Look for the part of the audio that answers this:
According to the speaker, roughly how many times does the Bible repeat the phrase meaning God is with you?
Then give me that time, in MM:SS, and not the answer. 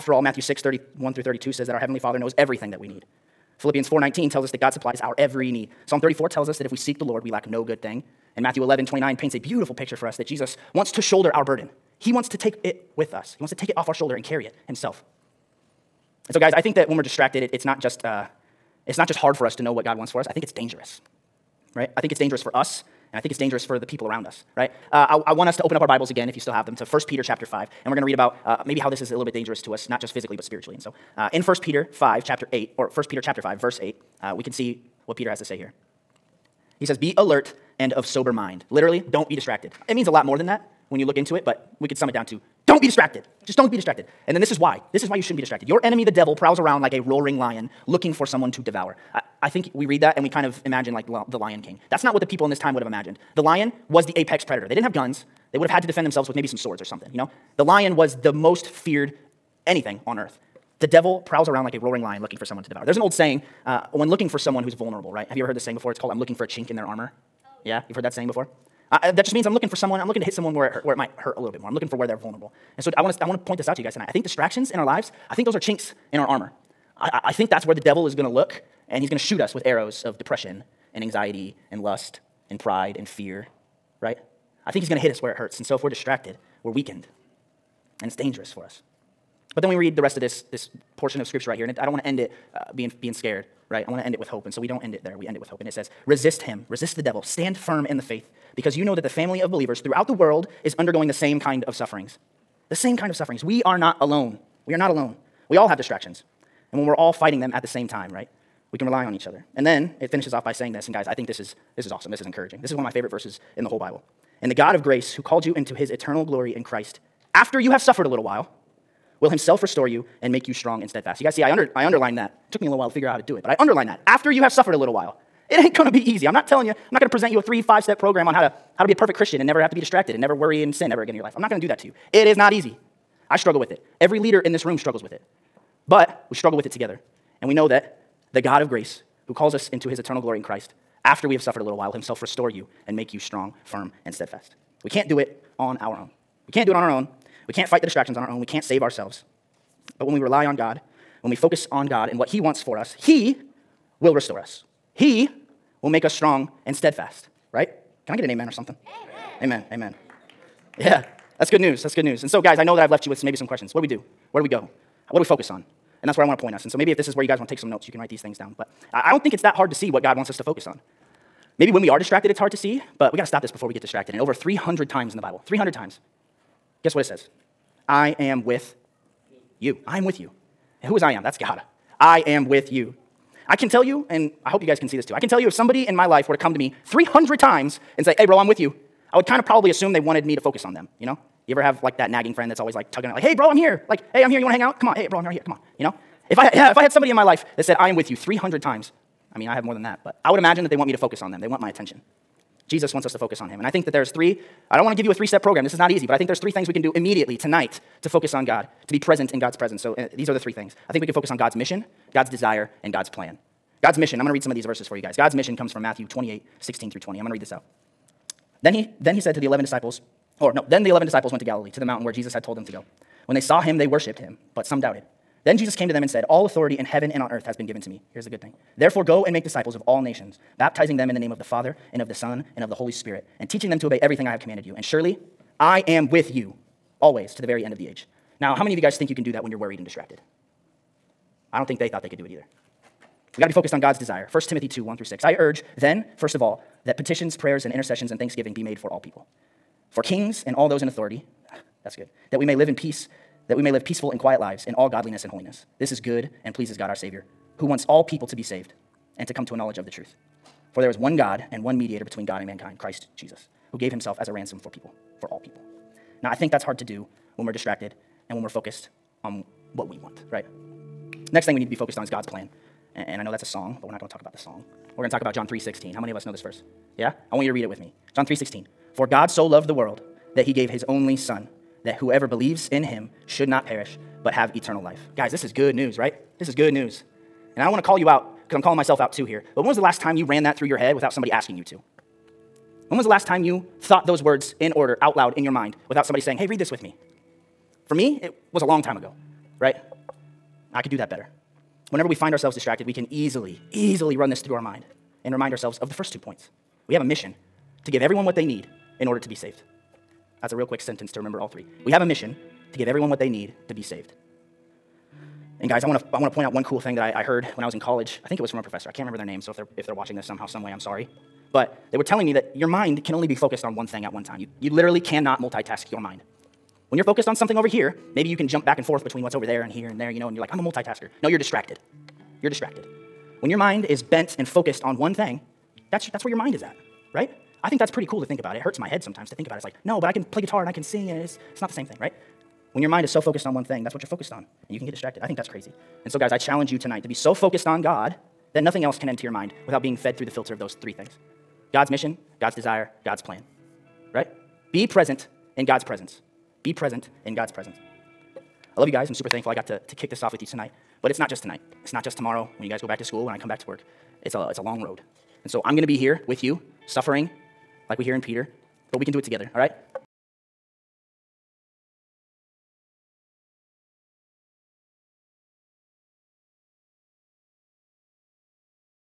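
02:54.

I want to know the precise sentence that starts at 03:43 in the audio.
When they saw him, they worshiped him, but some doubted.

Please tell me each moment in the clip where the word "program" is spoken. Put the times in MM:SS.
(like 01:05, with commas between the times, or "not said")
02:07, 03:25.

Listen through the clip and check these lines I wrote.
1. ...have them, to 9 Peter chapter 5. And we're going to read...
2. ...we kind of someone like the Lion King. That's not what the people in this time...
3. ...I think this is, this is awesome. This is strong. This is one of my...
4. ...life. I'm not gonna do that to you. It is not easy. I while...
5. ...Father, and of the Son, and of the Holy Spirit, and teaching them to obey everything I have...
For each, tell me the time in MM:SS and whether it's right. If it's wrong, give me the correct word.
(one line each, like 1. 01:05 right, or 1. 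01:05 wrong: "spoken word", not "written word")
1. 00:26 wrong: "1", not "9"
2. 00:50 wrong: "imagine", not "someone"
3. 01:51 wrong: "encouraging", not "strong"
4. 02:11 wrong: "struggle", not "while"
5. 03:51 right.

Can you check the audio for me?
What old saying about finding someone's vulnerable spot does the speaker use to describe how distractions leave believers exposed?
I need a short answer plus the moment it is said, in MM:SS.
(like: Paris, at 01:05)
chink in their armor, at 01:06.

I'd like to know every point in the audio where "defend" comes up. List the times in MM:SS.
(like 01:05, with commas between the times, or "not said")
00:55.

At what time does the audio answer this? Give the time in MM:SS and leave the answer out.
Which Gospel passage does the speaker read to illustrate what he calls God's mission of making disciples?
03:35.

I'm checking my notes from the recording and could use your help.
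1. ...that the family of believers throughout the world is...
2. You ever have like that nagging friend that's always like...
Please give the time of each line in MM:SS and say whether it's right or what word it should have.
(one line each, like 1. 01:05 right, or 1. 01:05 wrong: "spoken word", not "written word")
1. 01:38 right
2. 03:11 right.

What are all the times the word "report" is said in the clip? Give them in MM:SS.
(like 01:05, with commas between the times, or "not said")
not said.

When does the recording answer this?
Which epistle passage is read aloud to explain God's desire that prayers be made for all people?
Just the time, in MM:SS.
04:04.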